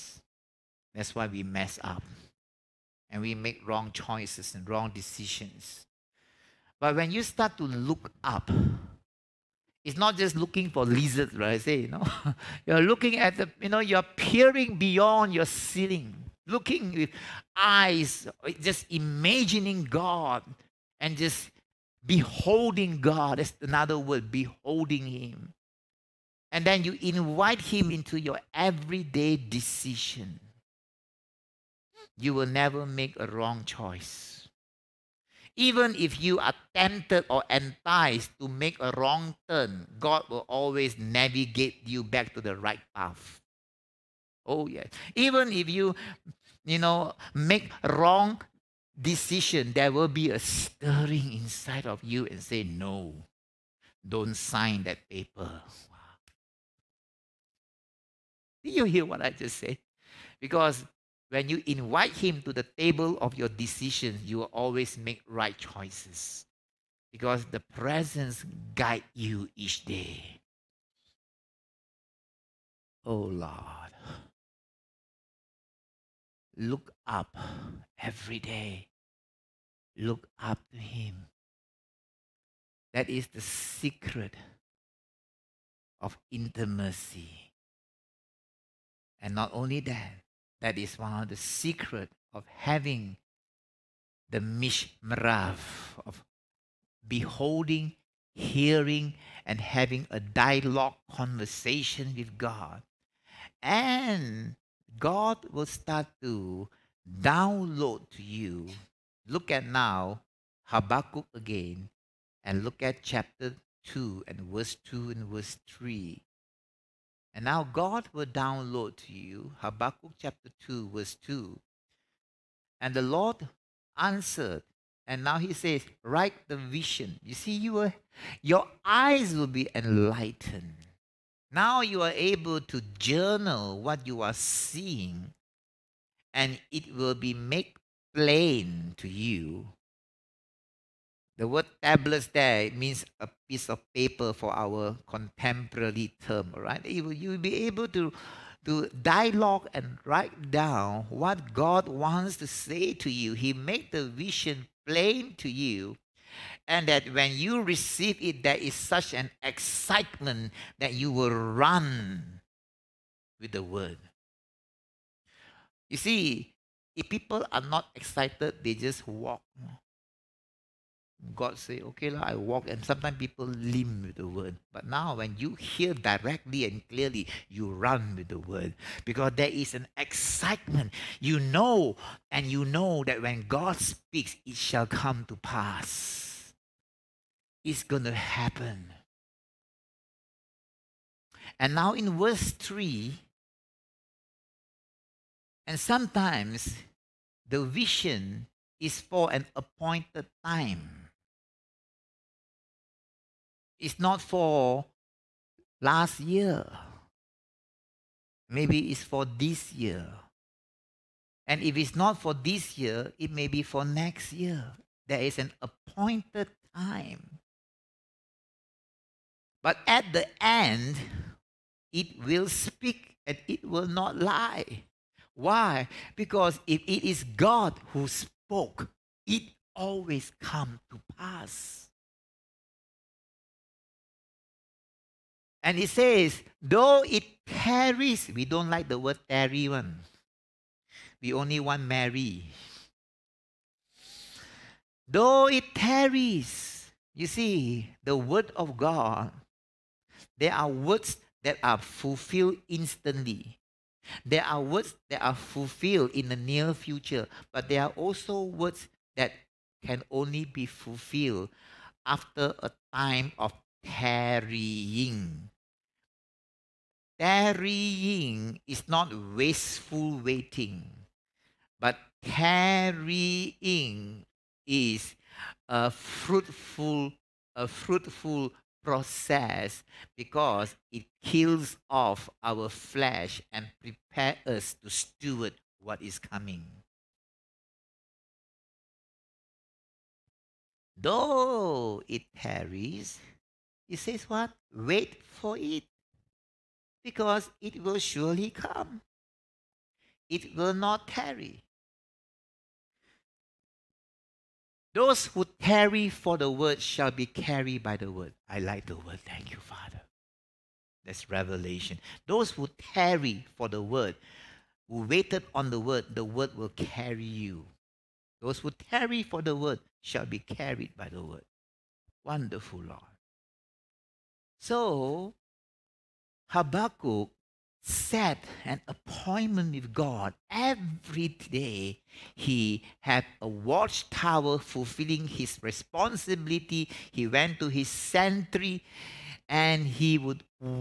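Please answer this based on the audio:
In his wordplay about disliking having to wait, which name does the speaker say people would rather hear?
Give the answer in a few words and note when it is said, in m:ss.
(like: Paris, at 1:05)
Mary, at 4:01.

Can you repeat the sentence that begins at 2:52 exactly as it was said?
And sometimes people limp with the word.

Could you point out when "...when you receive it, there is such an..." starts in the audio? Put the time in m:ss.
2:37.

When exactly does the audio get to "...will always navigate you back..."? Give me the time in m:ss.
0:40.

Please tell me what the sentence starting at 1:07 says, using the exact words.
Because the presence guide you each day.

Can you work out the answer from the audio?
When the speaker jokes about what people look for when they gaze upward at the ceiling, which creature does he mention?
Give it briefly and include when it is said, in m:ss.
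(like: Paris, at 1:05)
Lizards, at 0:10.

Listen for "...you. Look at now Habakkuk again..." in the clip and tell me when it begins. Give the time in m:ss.
1:48.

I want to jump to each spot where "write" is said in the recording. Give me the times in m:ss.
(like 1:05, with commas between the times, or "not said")
2:06, 2:30.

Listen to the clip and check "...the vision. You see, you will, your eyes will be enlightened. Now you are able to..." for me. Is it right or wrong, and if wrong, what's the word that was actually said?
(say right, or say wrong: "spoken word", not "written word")
right.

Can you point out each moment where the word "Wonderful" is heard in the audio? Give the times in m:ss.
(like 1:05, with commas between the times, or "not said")
5:22.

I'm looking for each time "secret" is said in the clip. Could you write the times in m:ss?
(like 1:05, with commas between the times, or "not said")
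1:23, 1:31.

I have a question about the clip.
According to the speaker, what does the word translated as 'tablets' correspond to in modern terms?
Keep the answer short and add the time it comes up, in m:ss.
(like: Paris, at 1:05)
A piece of paper, at 2:23.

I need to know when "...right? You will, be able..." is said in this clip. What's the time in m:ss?
2:26.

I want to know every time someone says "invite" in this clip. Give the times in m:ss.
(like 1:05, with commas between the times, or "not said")
0:27, 1:01.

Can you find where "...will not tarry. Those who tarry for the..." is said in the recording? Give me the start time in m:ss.
5:00.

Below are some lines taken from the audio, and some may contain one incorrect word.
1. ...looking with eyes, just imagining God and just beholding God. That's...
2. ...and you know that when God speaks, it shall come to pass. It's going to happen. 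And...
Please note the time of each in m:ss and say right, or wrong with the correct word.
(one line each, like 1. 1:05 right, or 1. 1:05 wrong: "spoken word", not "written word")
1. 0:16 right
2. 3:02 right.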